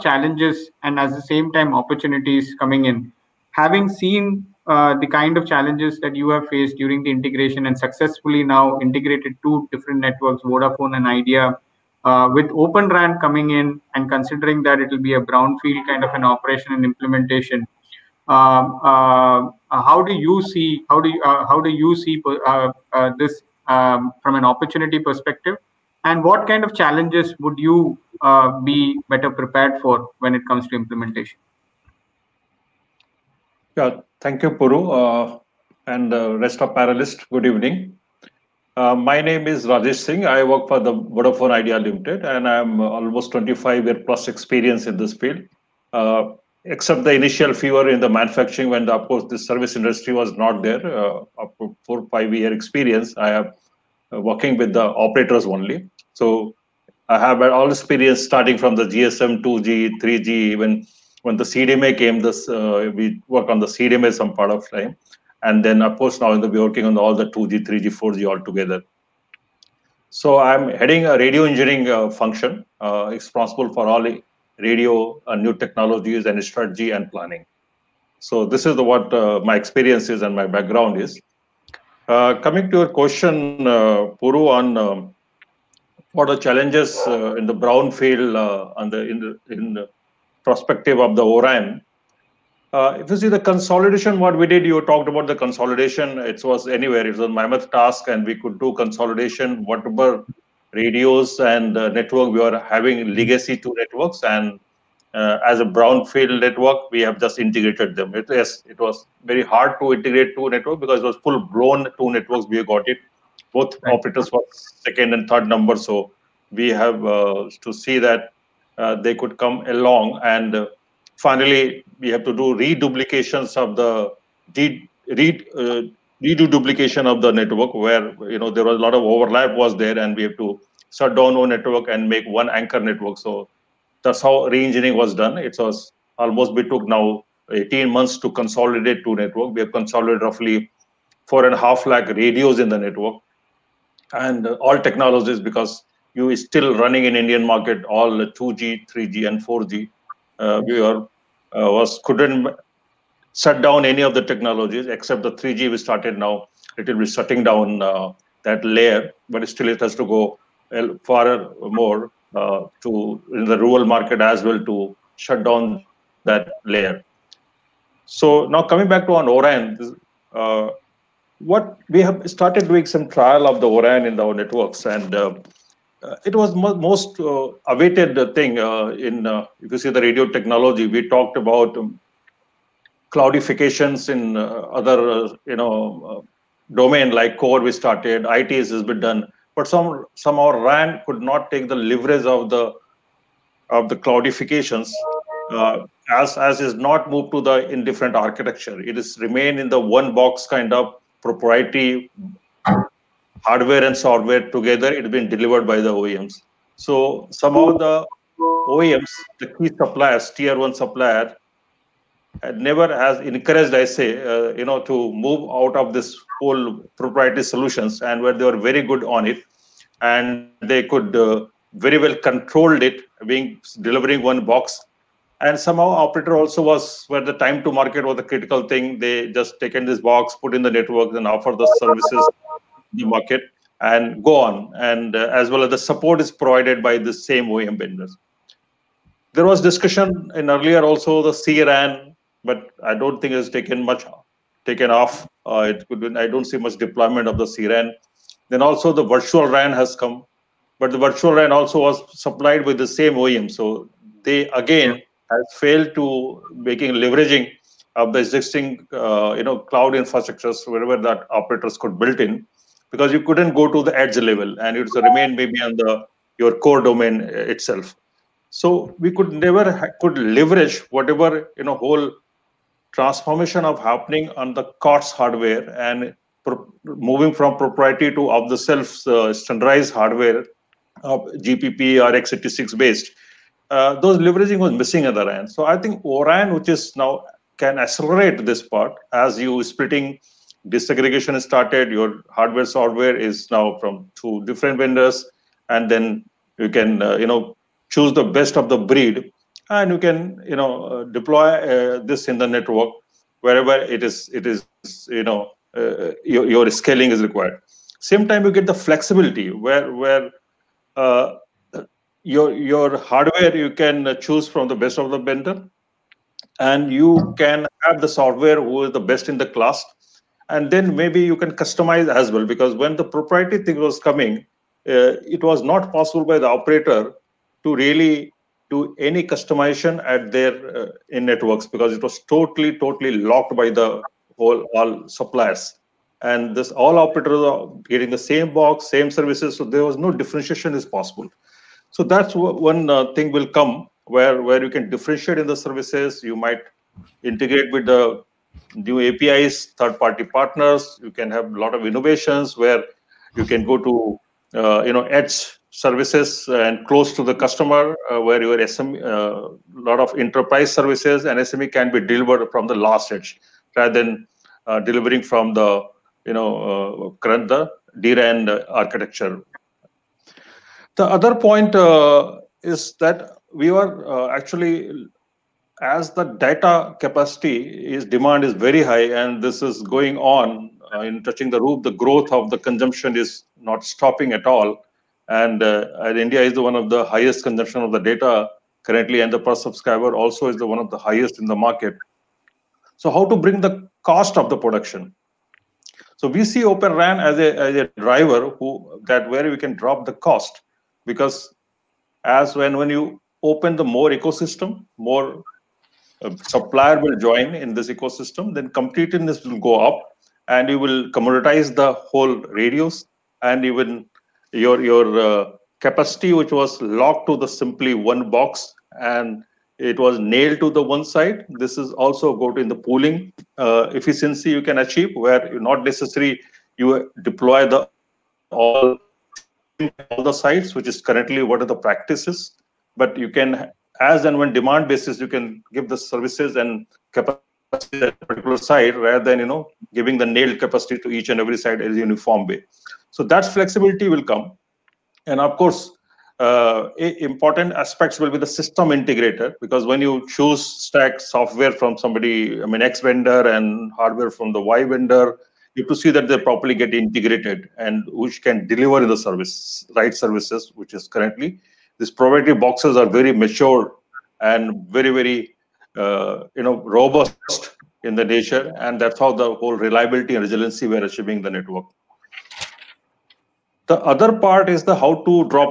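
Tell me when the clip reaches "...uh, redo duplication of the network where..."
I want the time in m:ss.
2:05.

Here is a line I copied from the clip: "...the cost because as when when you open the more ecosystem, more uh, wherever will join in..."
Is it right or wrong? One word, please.
wrong.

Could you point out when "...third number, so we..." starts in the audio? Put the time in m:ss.
1:55.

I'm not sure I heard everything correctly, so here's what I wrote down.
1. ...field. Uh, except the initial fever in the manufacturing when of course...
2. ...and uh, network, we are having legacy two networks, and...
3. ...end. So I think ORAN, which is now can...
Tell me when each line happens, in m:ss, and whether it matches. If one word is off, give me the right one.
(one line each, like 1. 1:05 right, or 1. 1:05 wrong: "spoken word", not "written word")
1. 0:45 right
2. 1:41 right
3. 4:45 right.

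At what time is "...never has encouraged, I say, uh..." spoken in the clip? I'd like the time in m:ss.
3:32.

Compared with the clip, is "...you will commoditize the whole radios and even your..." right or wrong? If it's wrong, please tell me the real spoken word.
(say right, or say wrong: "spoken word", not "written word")
right.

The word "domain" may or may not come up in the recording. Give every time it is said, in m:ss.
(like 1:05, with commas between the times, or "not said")
3:06, 4:26.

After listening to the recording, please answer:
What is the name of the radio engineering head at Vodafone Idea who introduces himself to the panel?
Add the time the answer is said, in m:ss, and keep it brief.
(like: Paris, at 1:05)
Rajesh Singh, at 0:39.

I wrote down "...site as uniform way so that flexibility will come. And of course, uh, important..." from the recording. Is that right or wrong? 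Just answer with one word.
right.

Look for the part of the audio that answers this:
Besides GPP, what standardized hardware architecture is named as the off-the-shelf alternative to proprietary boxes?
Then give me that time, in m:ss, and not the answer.
4:42.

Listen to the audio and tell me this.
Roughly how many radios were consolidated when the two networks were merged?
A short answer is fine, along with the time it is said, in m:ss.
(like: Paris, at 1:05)
four and a half lakh, at 2:21.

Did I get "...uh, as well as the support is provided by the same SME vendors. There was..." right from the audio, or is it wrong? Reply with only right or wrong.
wrong.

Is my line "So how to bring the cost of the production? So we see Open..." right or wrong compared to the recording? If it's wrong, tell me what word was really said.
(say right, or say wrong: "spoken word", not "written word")
right.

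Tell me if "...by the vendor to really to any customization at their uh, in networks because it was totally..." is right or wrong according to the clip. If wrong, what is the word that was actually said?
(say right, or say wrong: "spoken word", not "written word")
wrong: "operator", not "vendor".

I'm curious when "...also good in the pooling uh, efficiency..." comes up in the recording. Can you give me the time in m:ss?
7:01.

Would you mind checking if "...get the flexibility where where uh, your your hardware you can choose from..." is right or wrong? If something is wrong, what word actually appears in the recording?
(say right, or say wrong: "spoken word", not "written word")
right.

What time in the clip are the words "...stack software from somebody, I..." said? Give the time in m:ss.
7:30.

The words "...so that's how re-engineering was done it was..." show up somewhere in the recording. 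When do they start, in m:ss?
2:13.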